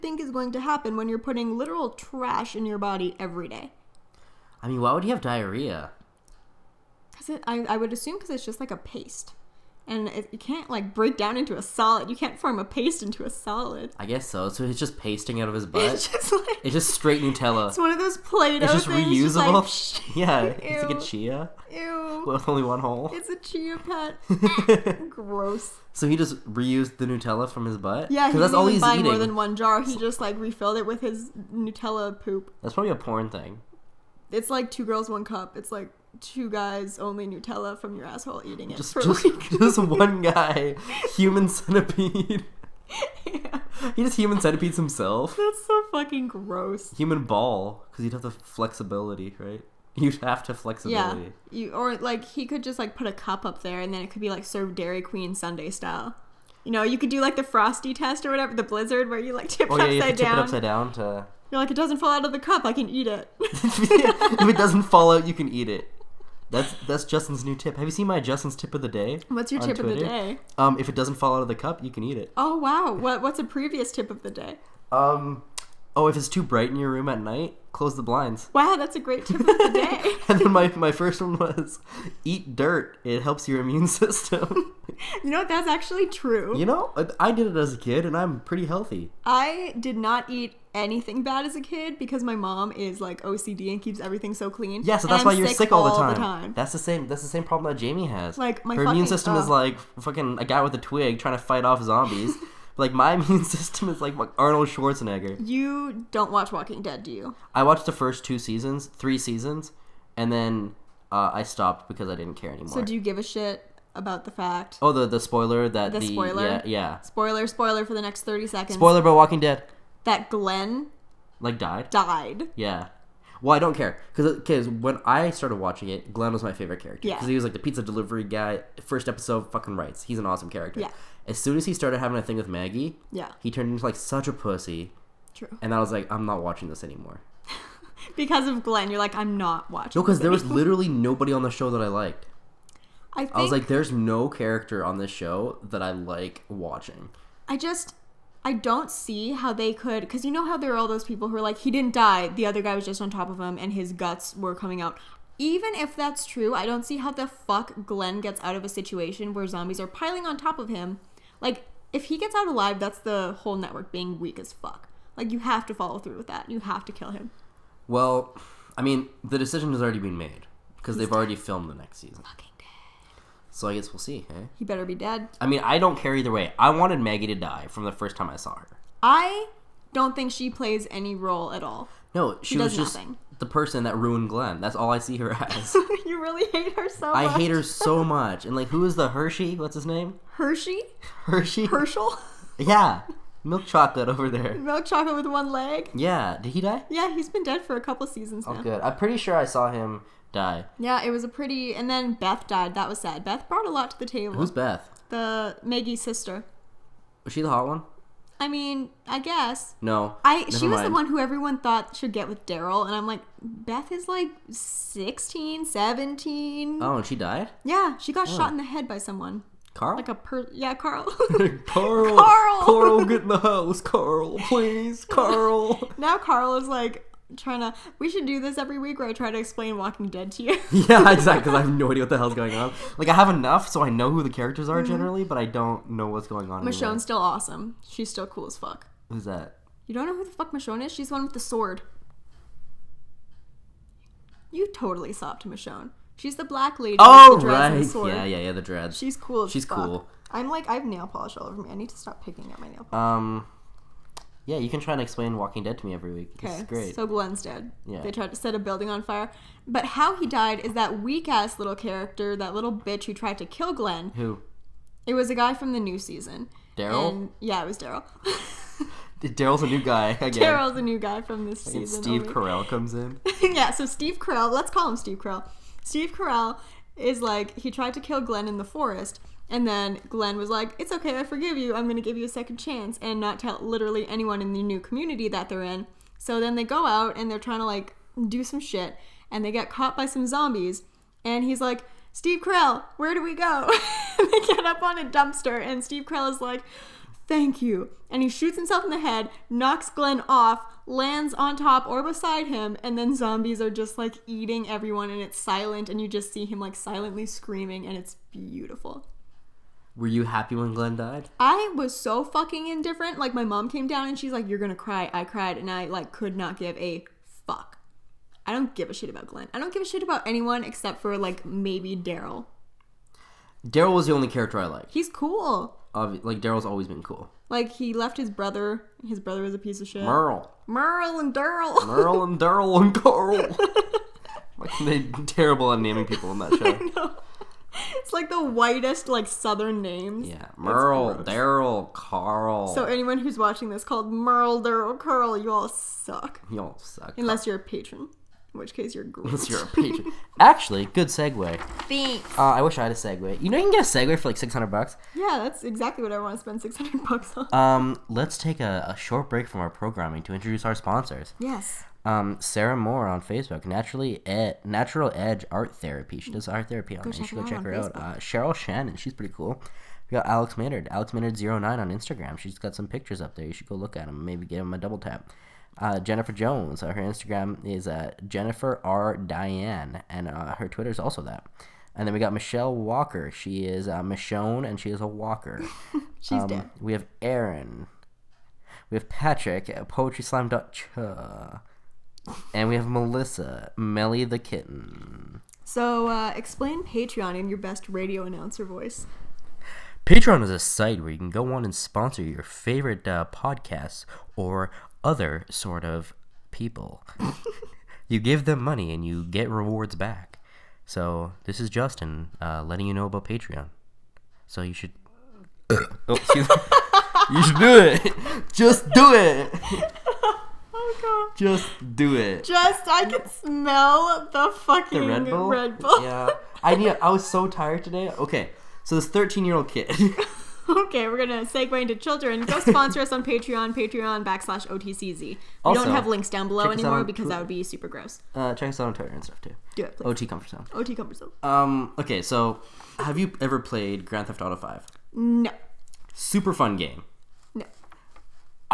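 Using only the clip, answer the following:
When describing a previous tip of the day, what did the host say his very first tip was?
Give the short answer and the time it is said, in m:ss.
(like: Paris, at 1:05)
Eat dirt, at 1:22.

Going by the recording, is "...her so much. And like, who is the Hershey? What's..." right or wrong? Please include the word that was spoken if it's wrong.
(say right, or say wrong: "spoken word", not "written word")
right.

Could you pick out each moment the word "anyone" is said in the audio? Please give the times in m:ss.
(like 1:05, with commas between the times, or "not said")
4:44, 5:20, 5:42.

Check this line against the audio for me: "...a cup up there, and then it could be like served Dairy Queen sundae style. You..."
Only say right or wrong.
right.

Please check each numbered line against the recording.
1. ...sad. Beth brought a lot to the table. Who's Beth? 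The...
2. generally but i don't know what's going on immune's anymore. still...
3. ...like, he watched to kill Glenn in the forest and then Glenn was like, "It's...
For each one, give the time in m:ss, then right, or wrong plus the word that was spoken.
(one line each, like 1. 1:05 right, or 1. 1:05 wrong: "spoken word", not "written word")
1. 3:22 right
2. 3:54 wrong: "michonne", not "immune"
3. 4:37 wrong: "tried", not "watched".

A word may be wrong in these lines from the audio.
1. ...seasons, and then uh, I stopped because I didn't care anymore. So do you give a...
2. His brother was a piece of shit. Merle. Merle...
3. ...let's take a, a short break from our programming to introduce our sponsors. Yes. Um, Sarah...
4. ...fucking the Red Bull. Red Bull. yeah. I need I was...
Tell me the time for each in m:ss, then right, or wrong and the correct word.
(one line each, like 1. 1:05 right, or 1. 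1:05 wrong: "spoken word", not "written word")
1. 1:49 right
2. 5:29 right
3. 5:58 right
4. 7:04 right.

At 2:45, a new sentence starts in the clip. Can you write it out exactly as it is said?
Like, you have to follow through with that.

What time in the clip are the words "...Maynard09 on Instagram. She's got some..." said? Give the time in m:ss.
6:11.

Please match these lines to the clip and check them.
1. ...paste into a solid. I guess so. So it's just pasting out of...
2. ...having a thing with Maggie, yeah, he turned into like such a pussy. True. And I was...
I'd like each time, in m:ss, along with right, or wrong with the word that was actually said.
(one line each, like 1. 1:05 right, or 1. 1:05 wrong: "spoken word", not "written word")
1. 0:12 right
2. 2:11 right.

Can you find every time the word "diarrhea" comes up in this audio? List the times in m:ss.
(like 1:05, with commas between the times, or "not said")
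0:05.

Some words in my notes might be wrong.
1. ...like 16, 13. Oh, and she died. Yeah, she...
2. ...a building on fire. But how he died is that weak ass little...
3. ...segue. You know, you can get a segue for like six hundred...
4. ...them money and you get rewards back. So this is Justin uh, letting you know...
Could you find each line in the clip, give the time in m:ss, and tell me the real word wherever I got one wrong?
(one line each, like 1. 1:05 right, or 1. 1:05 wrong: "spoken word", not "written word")
1. 3:34 wrong: "17", not "13"
2. 4:18 right
3. 5:52 right
4. 6:48 right.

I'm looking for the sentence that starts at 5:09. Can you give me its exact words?
Were you happy when Glenn died?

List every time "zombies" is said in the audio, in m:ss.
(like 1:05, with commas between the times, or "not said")
1:41, 2:39, 4:50, 5:03.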